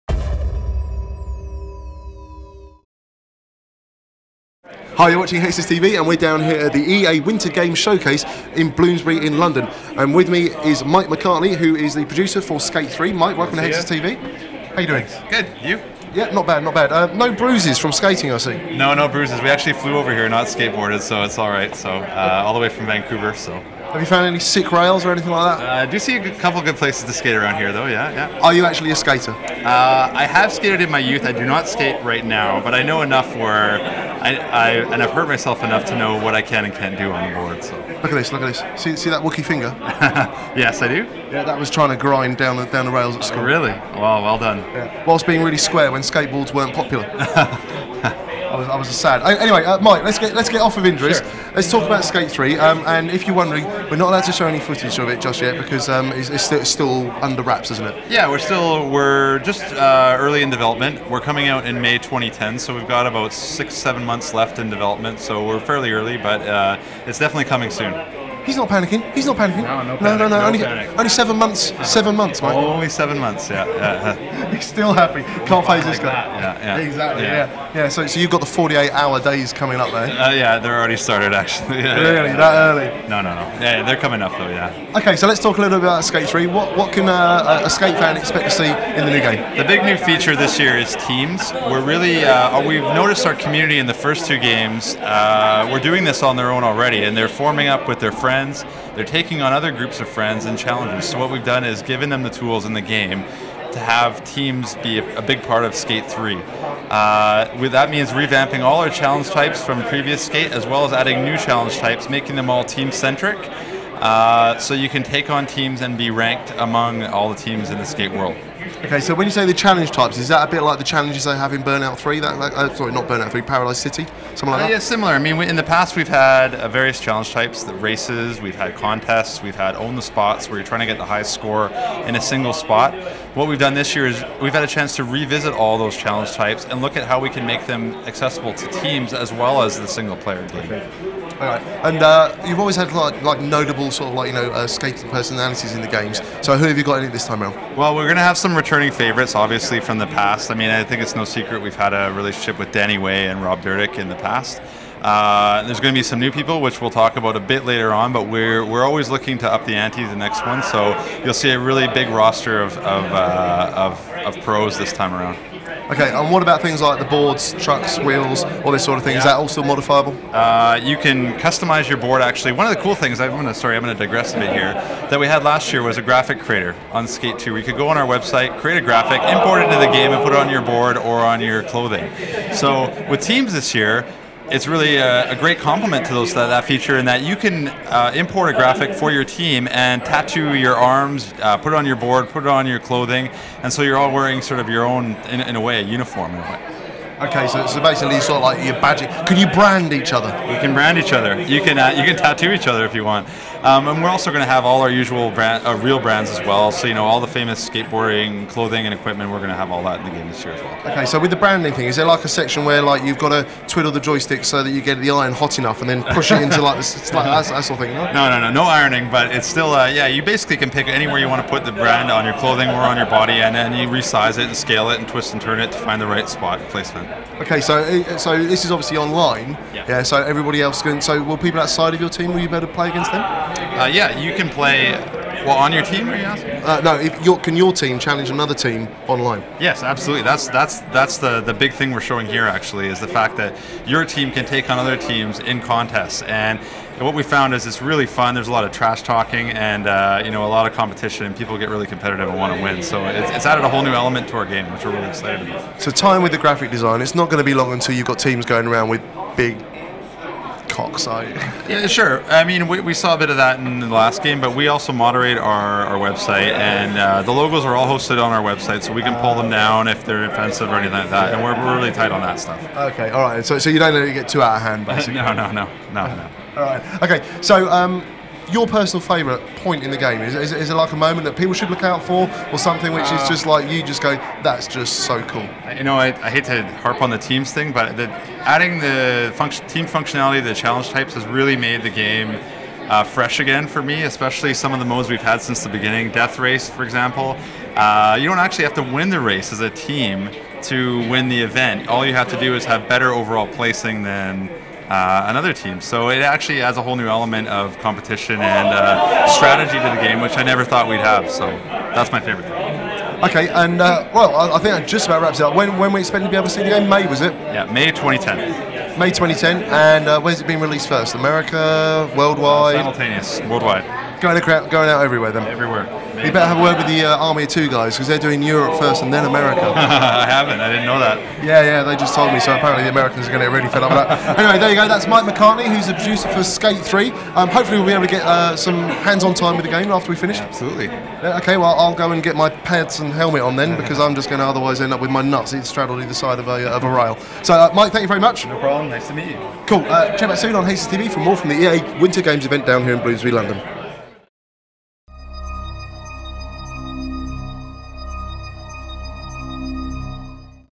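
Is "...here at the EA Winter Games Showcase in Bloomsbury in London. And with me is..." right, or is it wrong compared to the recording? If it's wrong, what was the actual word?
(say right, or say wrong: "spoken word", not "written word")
right.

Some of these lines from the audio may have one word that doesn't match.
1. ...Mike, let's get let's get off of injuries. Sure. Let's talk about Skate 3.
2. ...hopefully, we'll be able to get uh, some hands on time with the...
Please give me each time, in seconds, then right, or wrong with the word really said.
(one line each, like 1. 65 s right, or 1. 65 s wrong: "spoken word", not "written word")
1. 49 s right
2. 337 s right.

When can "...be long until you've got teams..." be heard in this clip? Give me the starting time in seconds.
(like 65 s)
257 s.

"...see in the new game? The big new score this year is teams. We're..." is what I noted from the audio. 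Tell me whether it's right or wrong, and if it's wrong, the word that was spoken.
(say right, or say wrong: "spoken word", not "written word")
wrong: "feature", not "score".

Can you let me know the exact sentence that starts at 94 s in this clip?
Uh, we're doing this on their own already, and they're forming up with their friends friends.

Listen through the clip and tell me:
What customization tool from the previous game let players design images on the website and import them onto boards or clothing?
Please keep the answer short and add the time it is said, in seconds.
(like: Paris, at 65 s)
graphic creator, at 176 s.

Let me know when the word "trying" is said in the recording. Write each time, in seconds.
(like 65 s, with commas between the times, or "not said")
41 s, 130 s.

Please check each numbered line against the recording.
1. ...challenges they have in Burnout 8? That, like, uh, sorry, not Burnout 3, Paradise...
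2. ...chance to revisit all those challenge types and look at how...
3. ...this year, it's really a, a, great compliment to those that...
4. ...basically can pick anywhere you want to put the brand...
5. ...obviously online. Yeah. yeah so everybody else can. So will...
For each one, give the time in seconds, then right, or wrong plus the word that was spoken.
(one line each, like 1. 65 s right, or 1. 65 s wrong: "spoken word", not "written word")
1. 120 s wrong: "3", not "8"
2. 134 s right
3. 183 s right
4. 220 s right
5. 228 s right.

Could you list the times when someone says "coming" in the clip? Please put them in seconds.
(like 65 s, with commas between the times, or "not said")
61 s, 67 s, 79 s, 83 s.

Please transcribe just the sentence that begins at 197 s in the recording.
Okay, so, so basically, sort of like your badging.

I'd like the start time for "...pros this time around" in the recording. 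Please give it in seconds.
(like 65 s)
164 s.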